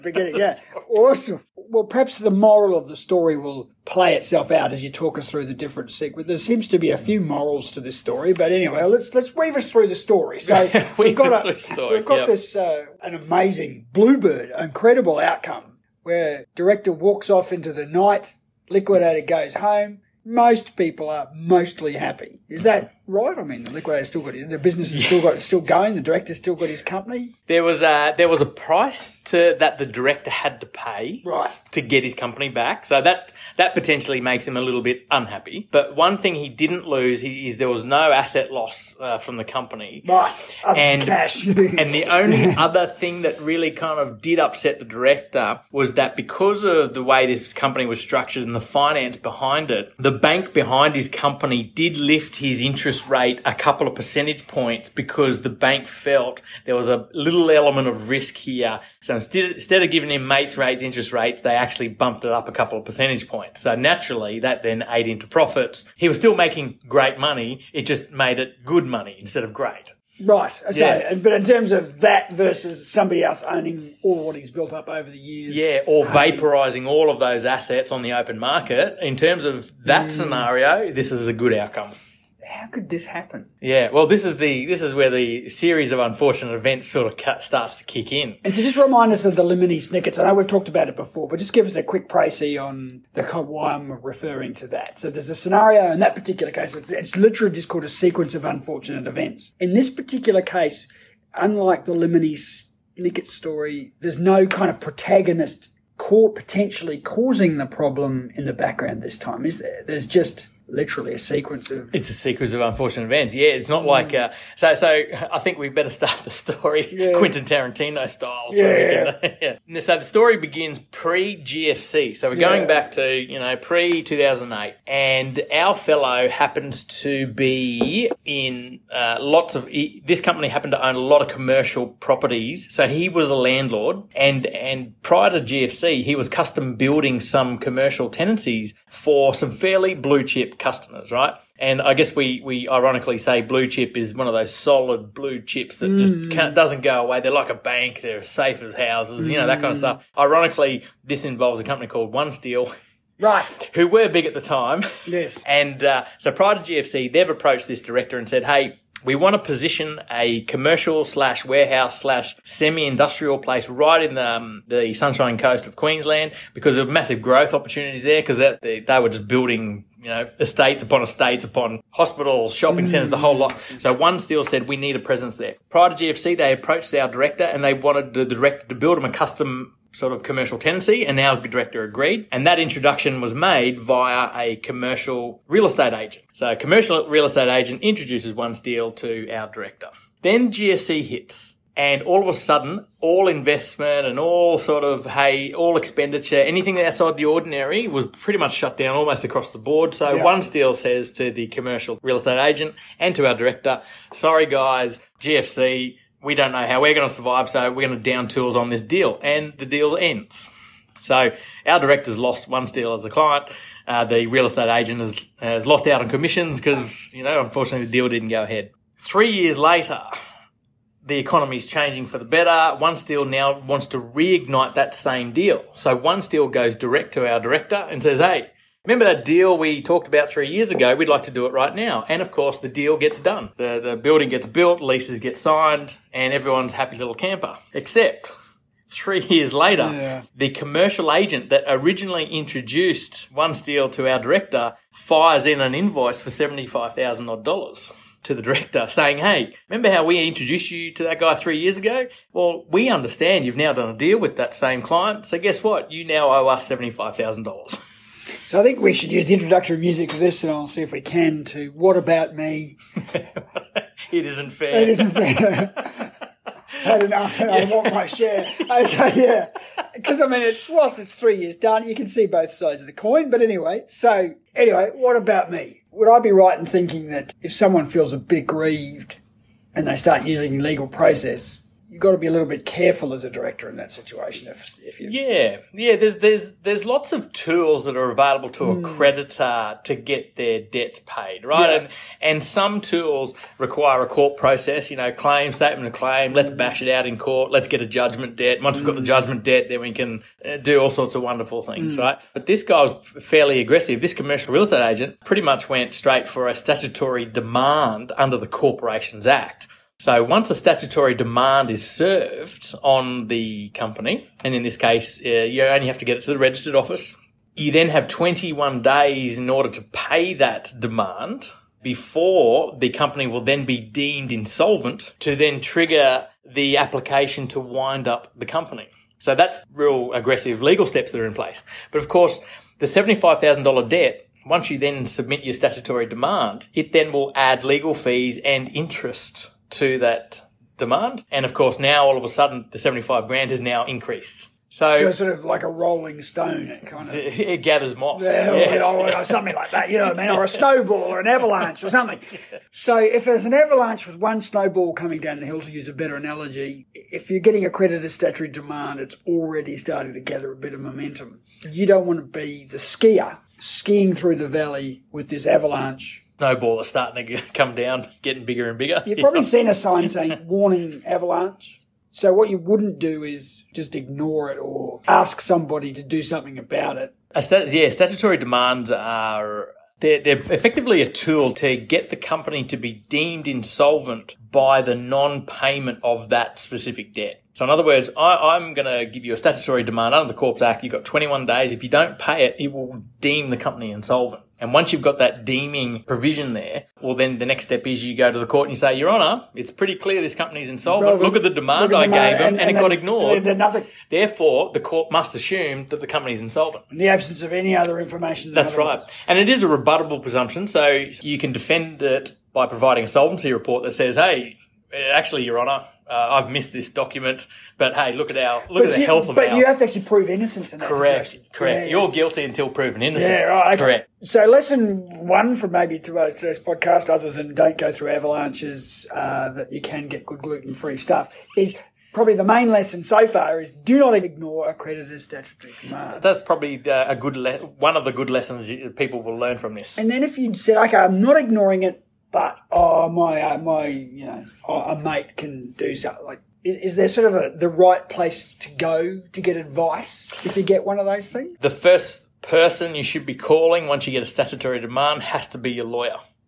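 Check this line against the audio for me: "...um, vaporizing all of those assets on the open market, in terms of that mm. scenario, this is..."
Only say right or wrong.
right.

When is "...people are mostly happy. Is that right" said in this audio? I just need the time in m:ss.
0:20.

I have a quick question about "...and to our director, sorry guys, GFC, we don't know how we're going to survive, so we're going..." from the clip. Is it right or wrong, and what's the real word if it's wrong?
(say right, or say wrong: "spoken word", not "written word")
right.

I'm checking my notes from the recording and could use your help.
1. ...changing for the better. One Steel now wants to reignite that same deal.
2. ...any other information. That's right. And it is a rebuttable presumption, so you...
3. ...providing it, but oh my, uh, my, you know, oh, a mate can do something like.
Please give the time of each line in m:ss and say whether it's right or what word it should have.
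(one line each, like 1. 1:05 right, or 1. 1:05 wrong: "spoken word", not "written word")
1. 3:41 right
2. 6:47 right
3. 7:21 wrong: "ignoring", not "providing".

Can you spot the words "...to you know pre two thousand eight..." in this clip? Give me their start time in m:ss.
2:02.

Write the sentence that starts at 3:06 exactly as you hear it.
So a commercial real estate agent introduces one steel to our director.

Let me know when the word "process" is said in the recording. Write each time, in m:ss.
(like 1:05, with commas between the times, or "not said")
4:40, 4:54.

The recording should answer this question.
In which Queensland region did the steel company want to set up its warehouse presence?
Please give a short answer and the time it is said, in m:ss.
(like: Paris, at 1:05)
Sunshine Coast, at 2:44.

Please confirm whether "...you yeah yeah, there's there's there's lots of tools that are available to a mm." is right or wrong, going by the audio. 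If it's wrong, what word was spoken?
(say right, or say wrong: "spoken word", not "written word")
right.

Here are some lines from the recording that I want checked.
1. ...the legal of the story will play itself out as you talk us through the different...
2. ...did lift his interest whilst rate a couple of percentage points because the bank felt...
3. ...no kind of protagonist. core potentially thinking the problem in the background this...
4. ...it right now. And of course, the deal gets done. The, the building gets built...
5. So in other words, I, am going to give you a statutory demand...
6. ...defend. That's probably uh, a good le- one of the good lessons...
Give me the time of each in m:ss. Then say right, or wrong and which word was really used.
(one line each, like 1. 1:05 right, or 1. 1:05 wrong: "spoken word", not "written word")
1. 0:02 wrong: "moral", not "legal"
2. 0:51 wrong: "interest", not "whilst"
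3. 1:44 wrong: "causing", not "thinking"
4. 3:51 right
5. 6:27 right
6. 7:15 wrong: "command", not "defend".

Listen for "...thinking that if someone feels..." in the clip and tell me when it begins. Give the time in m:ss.
4:36.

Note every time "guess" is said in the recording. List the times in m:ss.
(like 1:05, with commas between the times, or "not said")
2:21, 4:15.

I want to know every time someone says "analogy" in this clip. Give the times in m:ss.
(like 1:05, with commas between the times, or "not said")
5:56.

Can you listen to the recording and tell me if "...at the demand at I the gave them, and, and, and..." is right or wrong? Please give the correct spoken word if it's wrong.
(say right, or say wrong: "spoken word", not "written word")
right.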